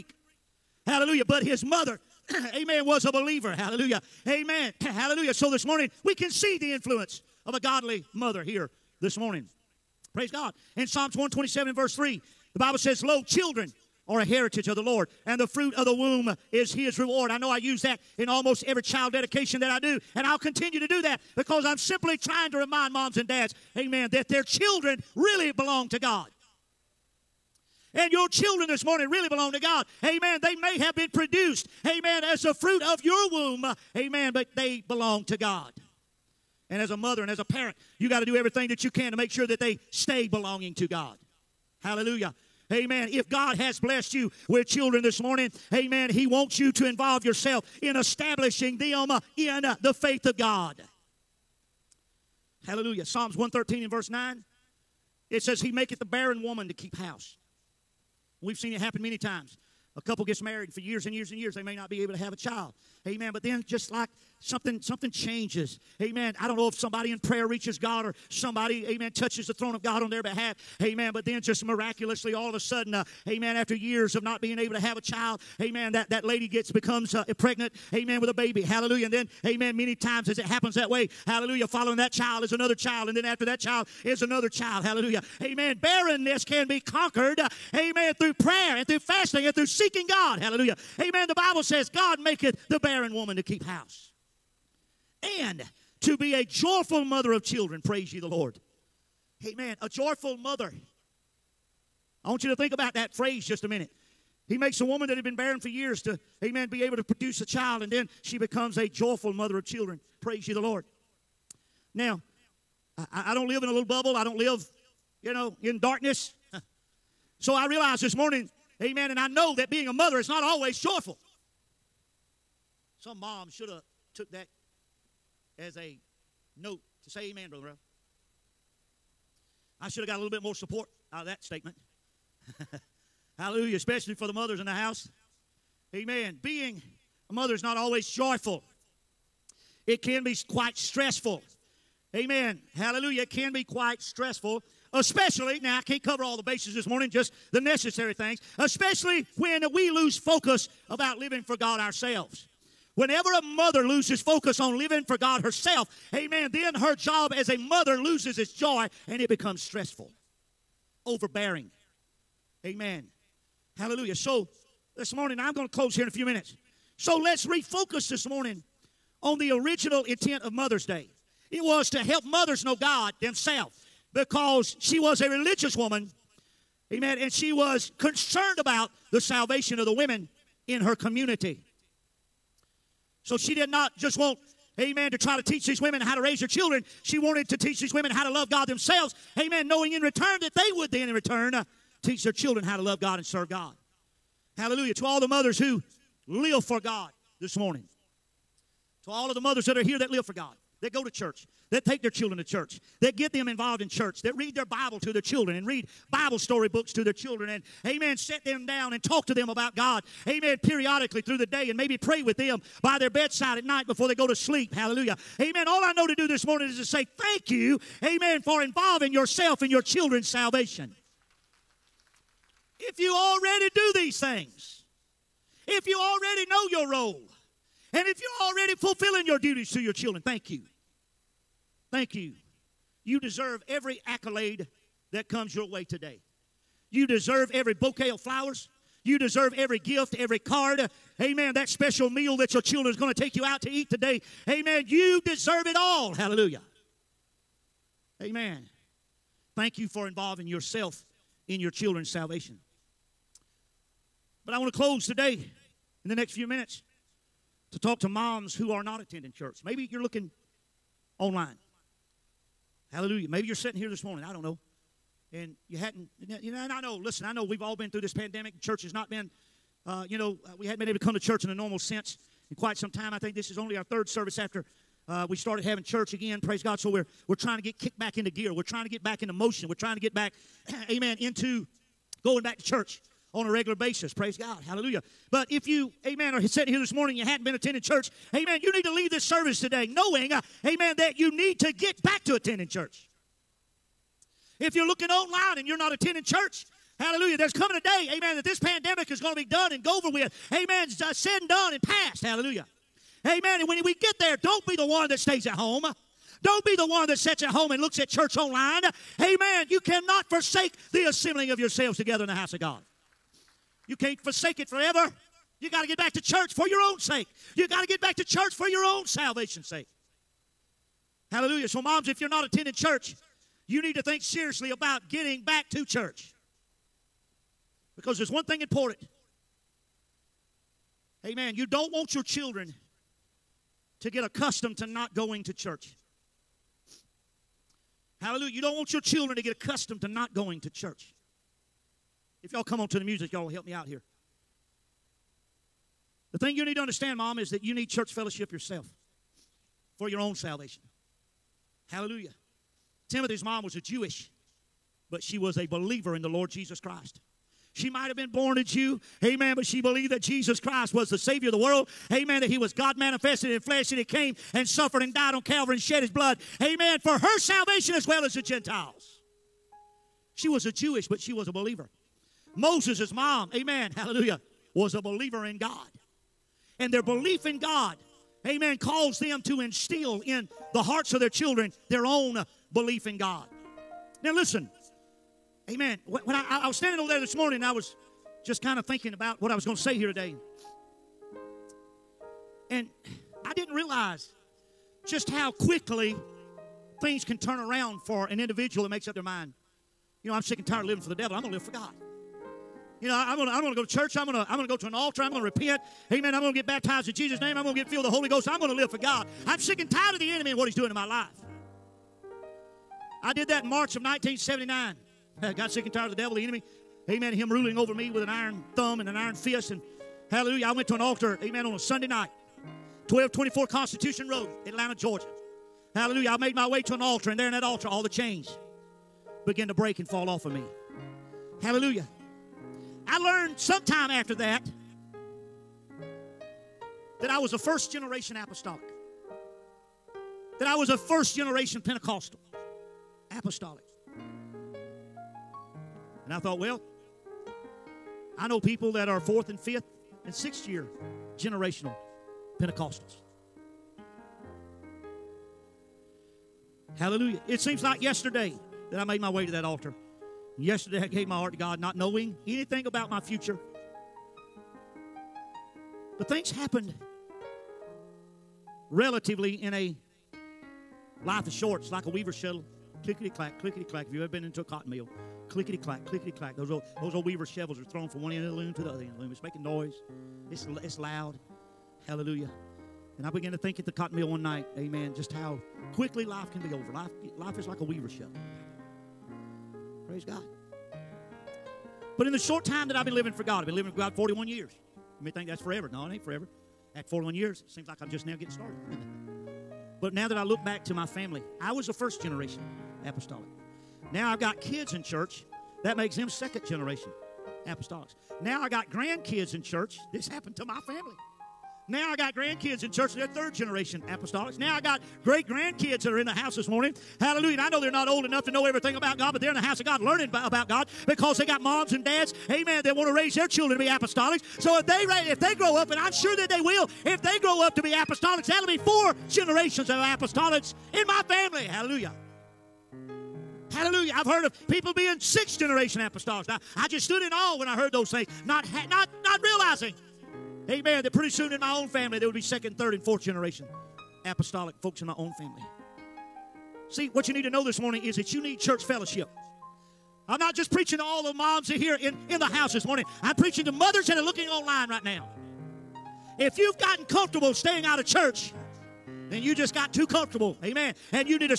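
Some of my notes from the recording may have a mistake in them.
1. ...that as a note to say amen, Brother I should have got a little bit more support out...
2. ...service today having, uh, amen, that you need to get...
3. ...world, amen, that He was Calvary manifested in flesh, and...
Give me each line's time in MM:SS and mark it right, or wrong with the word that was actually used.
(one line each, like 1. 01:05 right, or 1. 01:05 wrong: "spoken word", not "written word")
1. 02:04 right
2. 04:49 wrong: "knowing", not "having"
3. 06:01 wrong: "God", not "Calvary".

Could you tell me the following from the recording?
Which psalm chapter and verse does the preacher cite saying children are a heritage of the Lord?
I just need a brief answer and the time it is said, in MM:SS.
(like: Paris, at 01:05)
Psalms 127:3, at 00:10.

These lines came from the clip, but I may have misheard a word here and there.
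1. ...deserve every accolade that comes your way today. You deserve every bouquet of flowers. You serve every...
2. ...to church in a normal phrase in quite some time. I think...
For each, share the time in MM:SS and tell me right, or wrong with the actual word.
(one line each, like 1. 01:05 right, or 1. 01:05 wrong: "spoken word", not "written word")
1. 03:53 wrong: "deserve", not "serve"
2. 04:31 wrong: "sense", not "phrase".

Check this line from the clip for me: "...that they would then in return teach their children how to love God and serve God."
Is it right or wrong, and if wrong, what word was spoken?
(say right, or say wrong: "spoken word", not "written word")
right.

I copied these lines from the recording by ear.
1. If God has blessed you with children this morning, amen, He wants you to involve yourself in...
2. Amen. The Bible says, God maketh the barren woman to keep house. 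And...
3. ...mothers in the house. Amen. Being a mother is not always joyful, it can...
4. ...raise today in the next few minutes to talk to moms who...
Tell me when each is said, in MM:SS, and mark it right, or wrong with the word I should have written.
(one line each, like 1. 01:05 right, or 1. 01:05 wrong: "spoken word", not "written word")
1. 00:43 right
2. 01:30 right
3. 02:14 right
4. 04:14 wrong: "close", not "raise".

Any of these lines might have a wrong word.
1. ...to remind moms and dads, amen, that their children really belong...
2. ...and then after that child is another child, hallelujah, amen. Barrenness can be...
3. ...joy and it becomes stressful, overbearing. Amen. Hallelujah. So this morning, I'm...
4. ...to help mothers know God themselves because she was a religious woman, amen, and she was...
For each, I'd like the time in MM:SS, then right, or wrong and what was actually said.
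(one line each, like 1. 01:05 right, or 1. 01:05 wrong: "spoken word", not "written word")
1. 00:22 right
2. 01:23 right
3. 02:38 right
4. 02:51 right.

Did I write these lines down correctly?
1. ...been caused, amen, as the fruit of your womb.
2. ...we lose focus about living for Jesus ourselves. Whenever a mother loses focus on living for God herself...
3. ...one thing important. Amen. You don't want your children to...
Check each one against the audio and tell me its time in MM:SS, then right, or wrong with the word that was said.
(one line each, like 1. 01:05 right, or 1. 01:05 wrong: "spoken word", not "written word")
1. 00:30 wrong: "produced", not "caused"
2. 02:29 wrong: "God", not "Jesus"
3. 05:28 right.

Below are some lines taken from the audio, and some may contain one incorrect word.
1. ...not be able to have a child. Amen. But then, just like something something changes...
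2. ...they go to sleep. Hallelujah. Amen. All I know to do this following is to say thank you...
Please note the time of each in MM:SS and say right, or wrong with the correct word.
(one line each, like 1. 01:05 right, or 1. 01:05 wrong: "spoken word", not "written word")
1. 01:01 right
2. 03:34 wrong: "morning", not "following".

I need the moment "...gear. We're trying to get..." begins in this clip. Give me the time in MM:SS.
04:38.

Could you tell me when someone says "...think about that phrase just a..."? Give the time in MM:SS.
01:42.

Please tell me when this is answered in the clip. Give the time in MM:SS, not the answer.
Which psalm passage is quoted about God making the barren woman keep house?
00:53.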